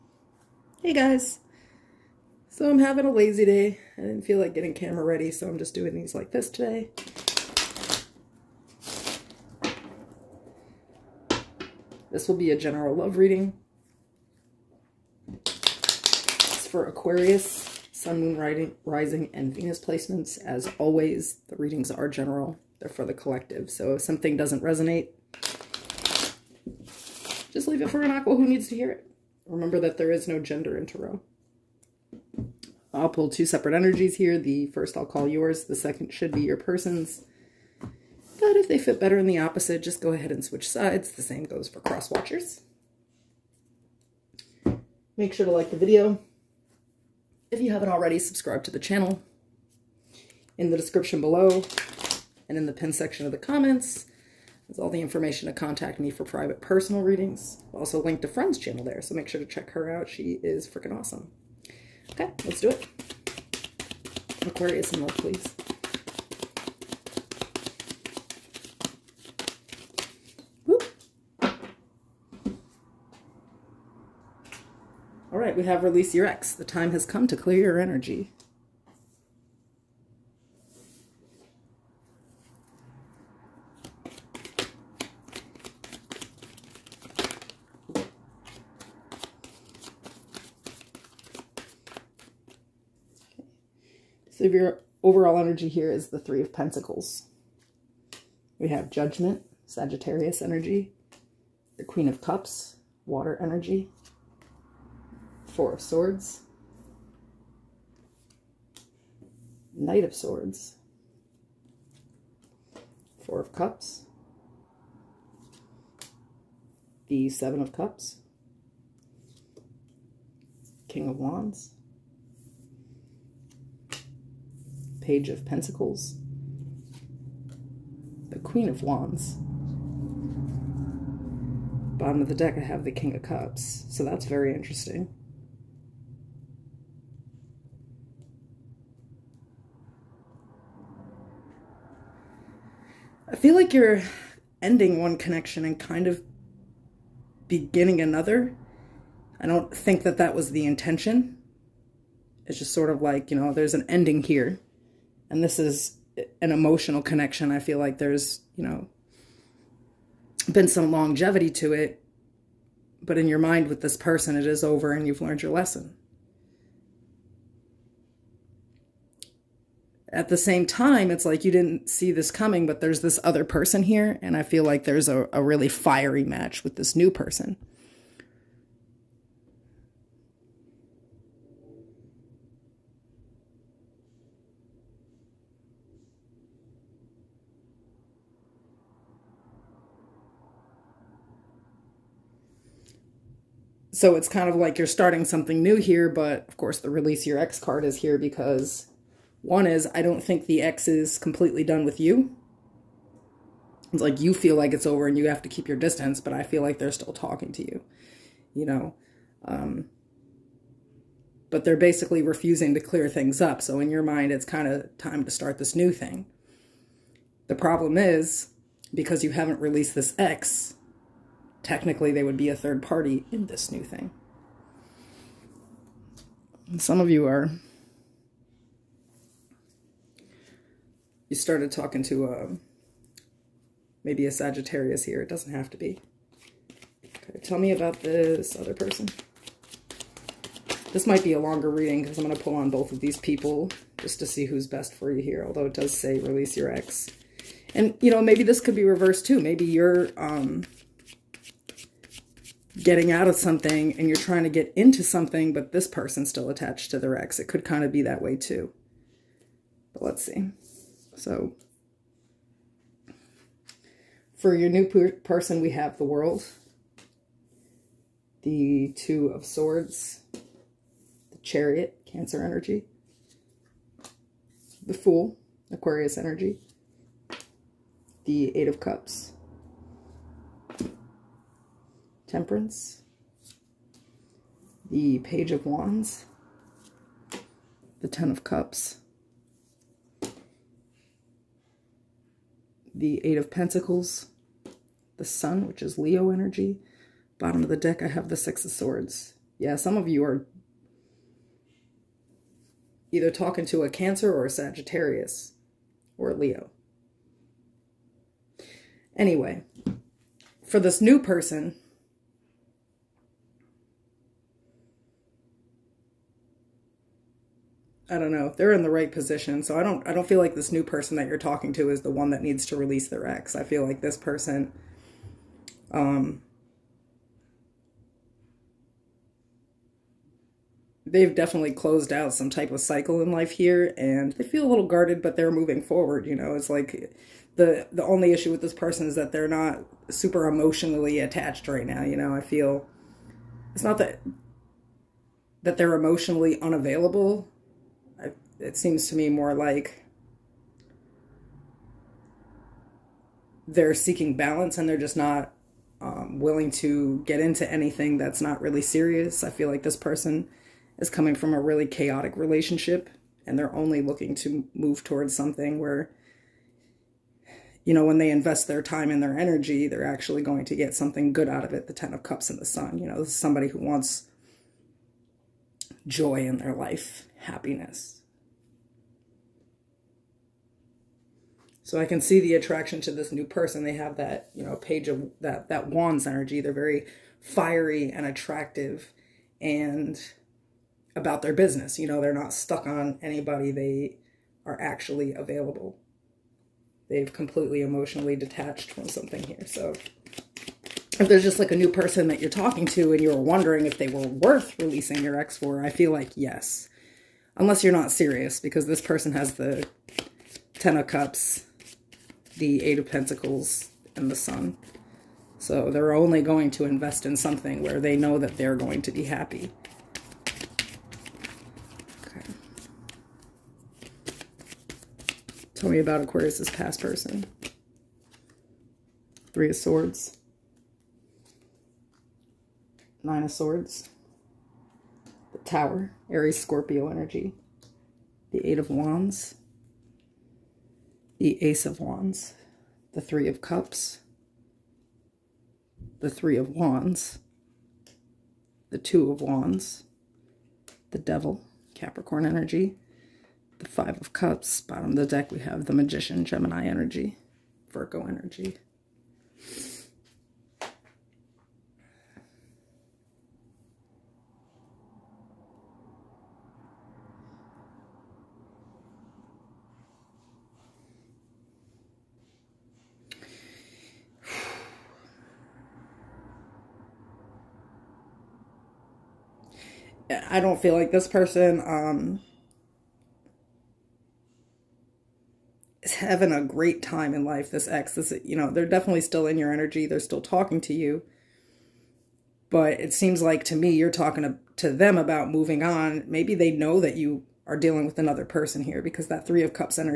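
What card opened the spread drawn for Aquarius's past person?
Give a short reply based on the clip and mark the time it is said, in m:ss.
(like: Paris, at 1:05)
Three of Swords, at 7:09.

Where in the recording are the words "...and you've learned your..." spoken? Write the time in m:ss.
2:44.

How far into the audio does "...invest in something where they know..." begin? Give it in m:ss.
6:56.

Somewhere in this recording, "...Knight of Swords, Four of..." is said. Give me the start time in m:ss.
1:49.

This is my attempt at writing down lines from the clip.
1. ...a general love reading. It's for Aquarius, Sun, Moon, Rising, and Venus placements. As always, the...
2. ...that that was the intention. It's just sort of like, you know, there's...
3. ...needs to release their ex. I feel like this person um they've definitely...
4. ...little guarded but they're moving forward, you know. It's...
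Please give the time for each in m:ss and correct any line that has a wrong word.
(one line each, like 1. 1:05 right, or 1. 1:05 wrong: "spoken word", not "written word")
1. 0:12 right
2. 2:30 right
3. 5:22 right
4. 5:34 right.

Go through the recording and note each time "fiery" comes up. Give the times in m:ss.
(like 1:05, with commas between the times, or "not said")
2:55, 6:27.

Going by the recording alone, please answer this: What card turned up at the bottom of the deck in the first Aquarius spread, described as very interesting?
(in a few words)
King of Cups.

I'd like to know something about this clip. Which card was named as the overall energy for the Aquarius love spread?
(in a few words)
Three of Pentacles.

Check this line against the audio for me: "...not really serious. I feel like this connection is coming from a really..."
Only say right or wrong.
wrong.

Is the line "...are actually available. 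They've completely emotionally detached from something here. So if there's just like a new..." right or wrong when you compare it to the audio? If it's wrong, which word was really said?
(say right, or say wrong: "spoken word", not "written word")
right.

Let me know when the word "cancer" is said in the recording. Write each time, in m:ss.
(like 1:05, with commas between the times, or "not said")
4:32, 5:03.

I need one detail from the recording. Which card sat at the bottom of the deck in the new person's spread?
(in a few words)
Six of Swords.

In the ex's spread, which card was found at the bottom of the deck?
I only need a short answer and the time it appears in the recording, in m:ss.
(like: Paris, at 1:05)
The Magician, at 7:35.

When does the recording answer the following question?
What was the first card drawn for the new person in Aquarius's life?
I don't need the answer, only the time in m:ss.
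4:25.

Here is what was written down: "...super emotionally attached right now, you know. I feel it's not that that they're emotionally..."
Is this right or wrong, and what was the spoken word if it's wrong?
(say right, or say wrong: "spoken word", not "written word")
right.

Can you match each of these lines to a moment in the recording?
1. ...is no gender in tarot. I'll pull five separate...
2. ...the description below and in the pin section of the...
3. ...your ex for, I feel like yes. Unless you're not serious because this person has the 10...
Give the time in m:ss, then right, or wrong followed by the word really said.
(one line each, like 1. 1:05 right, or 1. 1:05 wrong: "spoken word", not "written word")
1. 0:30 wrong: "two", not "five"
2. 0:50 right
3. 6:45 right.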